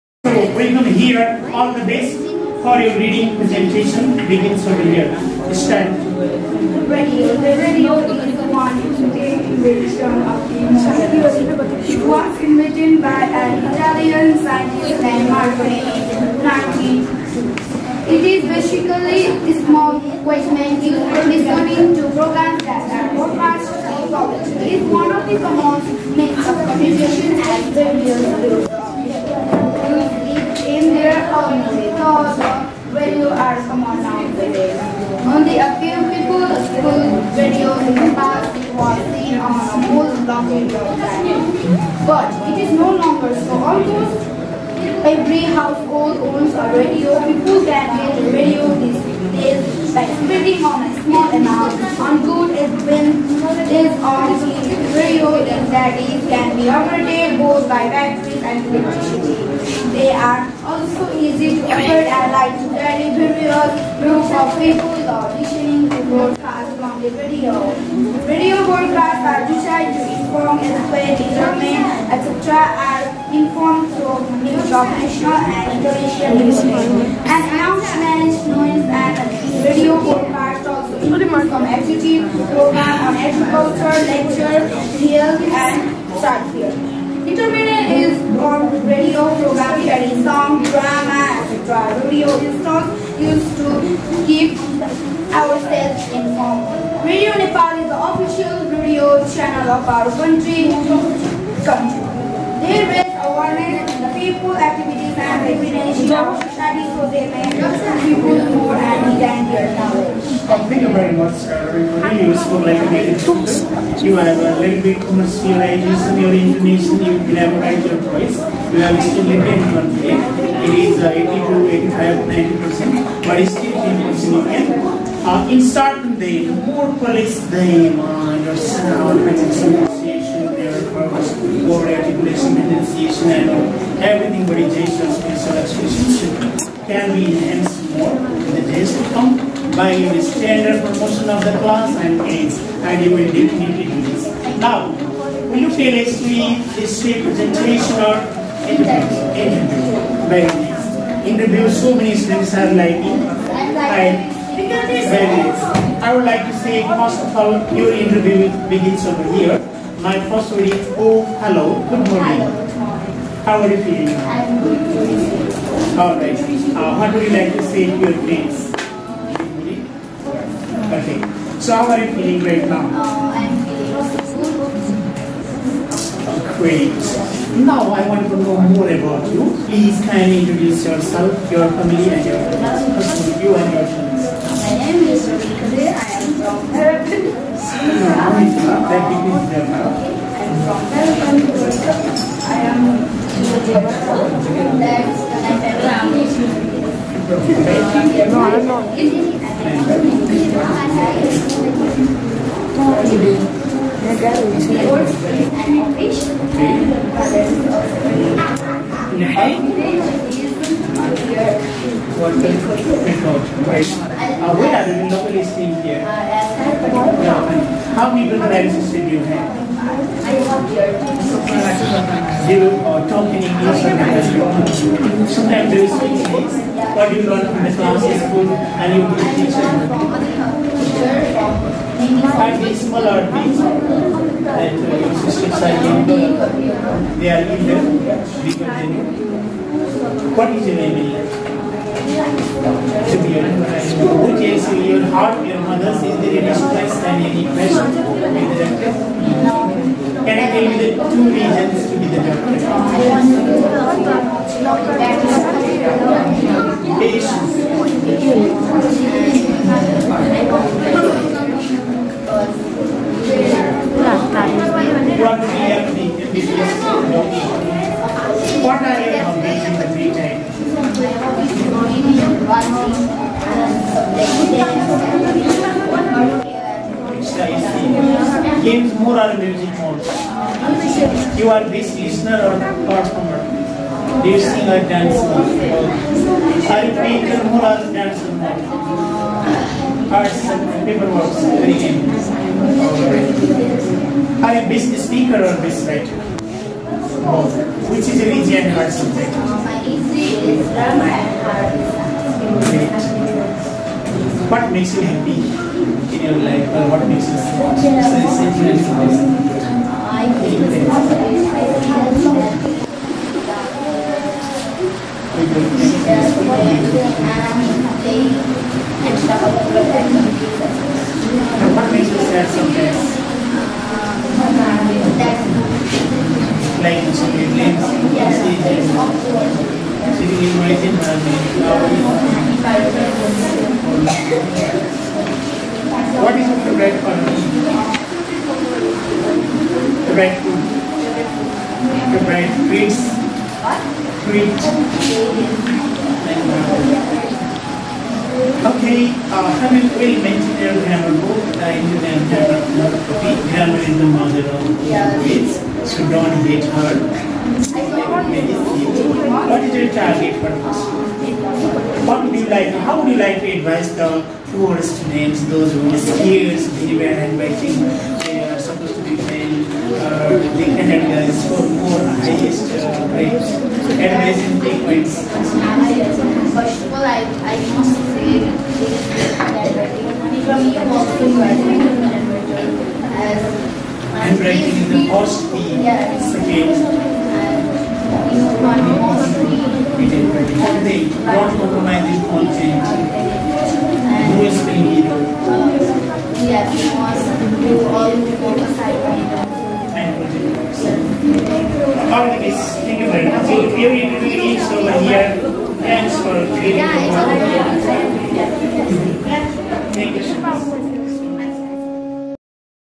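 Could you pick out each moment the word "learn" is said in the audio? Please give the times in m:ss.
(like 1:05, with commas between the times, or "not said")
3:47.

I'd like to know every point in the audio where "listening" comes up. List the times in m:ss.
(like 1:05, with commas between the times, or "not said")
0:21, 1:05.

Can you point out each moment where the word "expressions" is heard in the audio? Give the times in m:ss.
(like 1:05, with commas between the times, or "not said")
2:15.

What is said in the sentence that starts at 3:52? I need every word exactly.
Find these smaller things that uh, your systems in they are either bigger than you.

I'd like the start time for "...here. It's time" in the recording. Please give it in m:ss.
0:04.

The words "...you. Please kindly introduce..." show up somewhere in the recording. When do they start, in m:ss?
2:59.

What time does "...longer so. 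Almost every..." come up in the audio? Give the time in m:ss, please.
0:42.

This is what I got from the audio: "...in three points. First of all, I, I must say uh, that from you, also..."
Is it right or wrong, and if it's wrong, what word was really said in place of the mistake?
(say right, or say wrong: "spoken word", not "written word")
right.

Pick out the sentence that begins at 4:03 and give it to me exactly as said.
To be your heart, your mother says there is stress and any pressure with the doctor.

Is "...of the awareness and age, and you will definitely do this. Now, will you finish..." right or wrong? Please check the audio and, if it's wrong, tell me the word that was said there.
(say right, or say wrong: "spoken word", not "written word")
wrong: "class", not "awareness".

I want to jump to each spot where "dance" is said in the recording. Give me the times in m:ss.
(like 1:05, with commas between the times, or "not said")
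4:44.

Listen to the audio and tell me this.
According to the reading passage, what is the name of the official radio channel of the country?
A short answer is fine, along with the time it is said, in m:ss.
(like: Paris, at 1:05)
Radio Nepal, at 1:37.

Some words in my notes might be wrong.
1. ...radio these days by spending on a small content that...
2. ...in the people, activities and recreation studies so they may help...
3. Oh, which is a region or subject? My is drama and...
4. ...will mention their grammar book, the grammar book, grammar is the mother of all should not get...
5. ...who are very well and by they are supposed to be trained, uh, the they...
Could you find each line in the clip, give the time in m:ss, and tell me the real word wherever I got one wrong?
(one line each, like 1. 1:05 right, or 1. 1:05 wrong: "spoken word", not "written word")
1. 0:48 wrong: "amount", not "content"
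2. 1:43 right
3. 4:57 right
4. 5:49 right
5. 6:05 right.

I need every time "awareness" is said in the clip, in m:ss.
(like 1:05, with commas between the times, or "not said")
1:43.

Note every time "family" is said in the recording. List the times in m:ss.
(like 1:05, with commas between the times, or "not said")
3:01, 3:17.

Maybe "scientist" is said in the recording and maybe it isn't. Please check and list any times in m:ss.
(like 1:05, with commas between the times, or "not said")
0:14.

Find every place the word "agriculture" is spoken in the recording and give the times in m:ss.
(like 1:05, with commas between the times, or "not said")
1:23.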